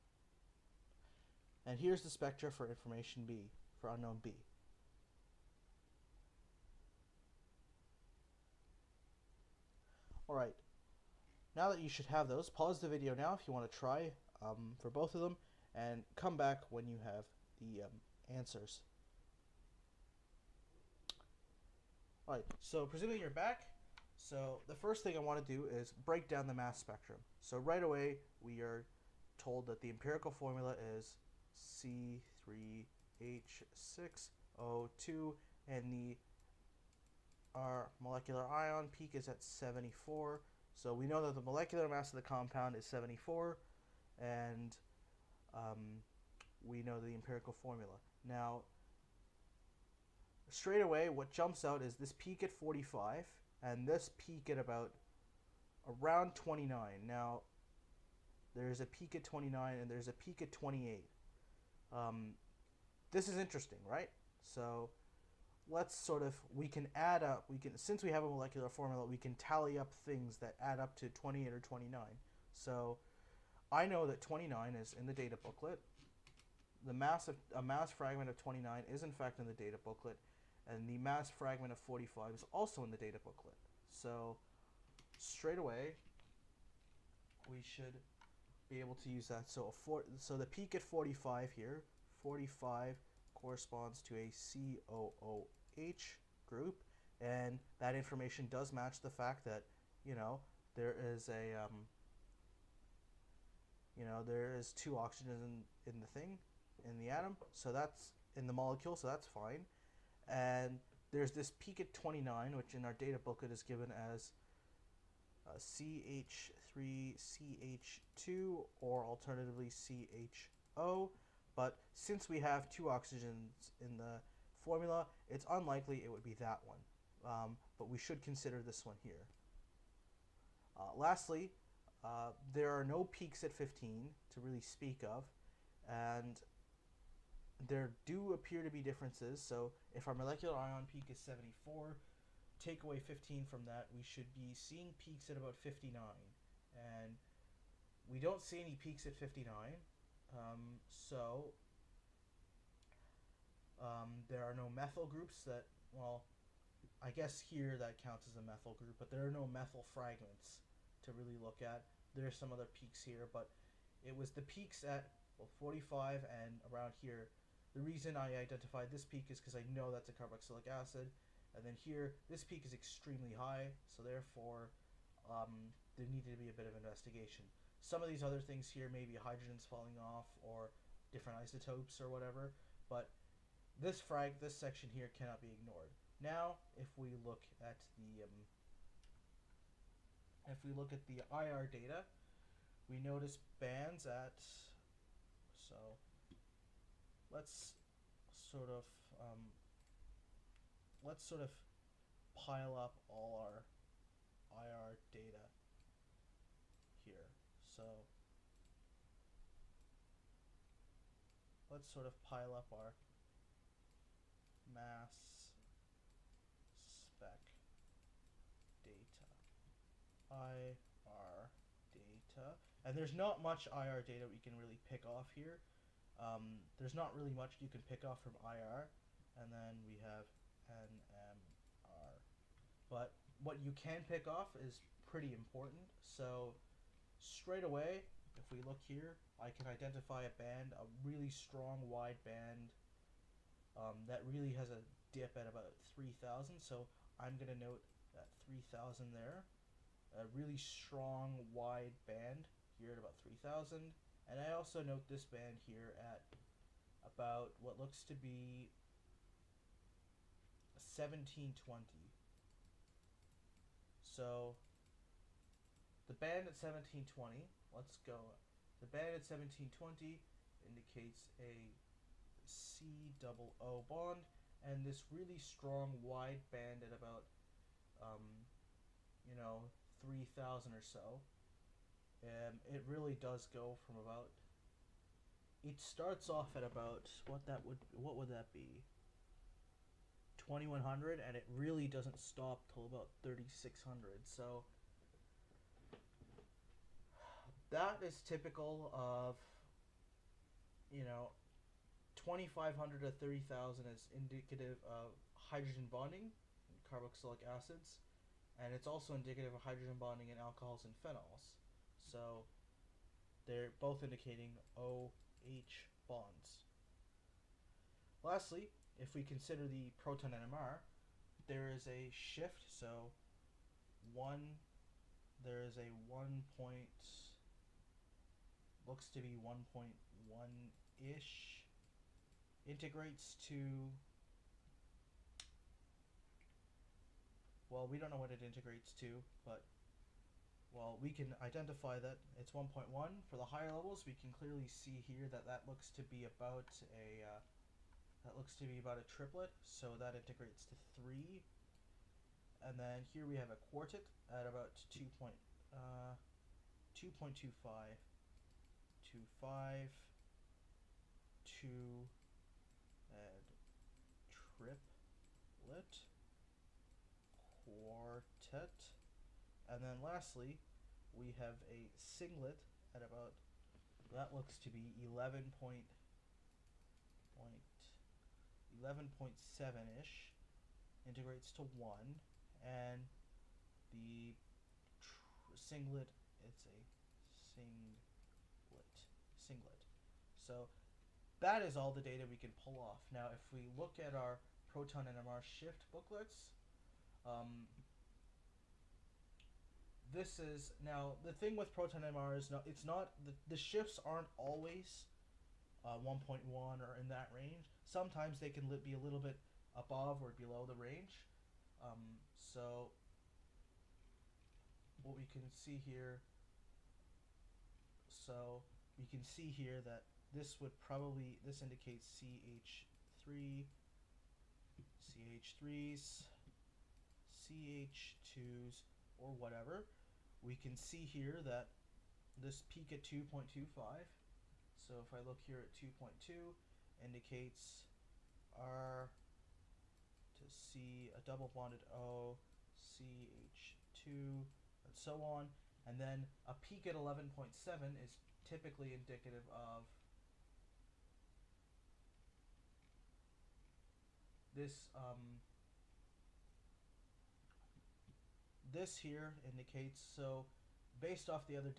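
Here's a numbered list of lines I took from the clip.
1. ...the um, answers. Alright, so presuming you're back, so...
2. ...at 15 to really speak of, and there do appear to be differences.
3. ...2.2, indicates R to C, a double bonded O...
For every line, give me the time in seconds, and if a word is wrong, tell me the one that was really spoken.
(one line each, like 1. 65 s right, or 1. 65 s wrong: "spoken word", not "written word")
1. 17 s right
2. 133 s right
3. 435 s right.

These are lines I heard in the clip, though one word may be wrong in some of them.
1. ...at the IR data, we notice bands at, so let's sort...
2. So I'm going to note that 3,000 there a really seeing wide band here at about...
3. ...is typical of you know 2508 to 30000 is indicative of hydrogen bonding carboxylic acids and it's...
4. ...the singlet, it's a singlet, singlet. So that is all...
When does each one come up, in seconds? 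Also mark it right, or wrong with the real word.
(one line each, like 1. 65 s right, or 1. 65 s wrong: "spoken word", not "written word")
1. 190 s right
2. 246 s wrong: "strong", not "seeing"
3. 298 s wrong: "2500", not "2508"
4. 383 s right.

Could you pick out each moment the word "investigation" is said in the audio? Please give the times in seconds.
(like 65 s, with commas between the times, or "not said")
176 s.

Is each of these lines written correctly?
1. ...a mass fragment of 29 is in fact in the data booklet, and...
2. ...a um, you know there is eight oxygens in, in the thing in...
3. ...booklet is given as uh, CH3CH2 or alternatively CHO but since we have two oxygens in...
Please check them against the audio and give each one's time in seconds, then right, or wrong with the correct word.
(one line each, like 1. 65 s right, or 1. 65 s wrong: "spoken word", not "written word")
1. 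77 s right
2. 101 s wrong: "two", not "eight"
3. 113 s right.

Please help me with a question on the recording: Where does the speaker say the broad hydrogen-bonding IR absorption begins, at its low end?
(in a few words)
2100.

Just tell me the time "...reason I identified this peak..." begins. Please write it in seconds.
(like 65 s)
167 s.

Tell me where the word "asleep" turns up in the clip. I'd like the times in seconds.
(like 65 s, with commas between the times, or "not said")
not said.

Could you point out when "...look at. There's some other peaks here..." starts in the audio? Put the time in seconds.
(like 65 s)
161 s.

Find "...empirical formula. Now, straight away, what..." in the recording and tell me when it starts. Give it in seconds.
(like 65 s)
47 s.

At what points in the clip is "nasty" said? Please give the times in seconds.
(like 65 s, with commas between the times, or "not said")
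not said.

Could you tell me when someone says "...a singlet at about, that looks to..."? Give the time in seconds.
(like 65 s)
371 s.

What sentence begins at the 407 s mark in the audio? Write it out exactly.
Sometimes they can be a little bit above or below the range.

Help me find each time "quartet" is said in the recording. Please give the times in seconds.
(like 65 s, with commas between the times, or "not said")
353 s, 367 s.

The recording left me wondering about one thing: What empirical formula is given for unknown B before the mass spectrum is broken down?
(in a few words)
C3H6O2.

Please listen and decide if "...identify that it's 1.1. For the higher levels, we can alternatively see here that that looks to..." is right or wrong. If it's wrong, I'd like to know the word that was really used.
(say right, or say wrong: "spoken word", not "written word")
wrong: "clearly", not "alternatively".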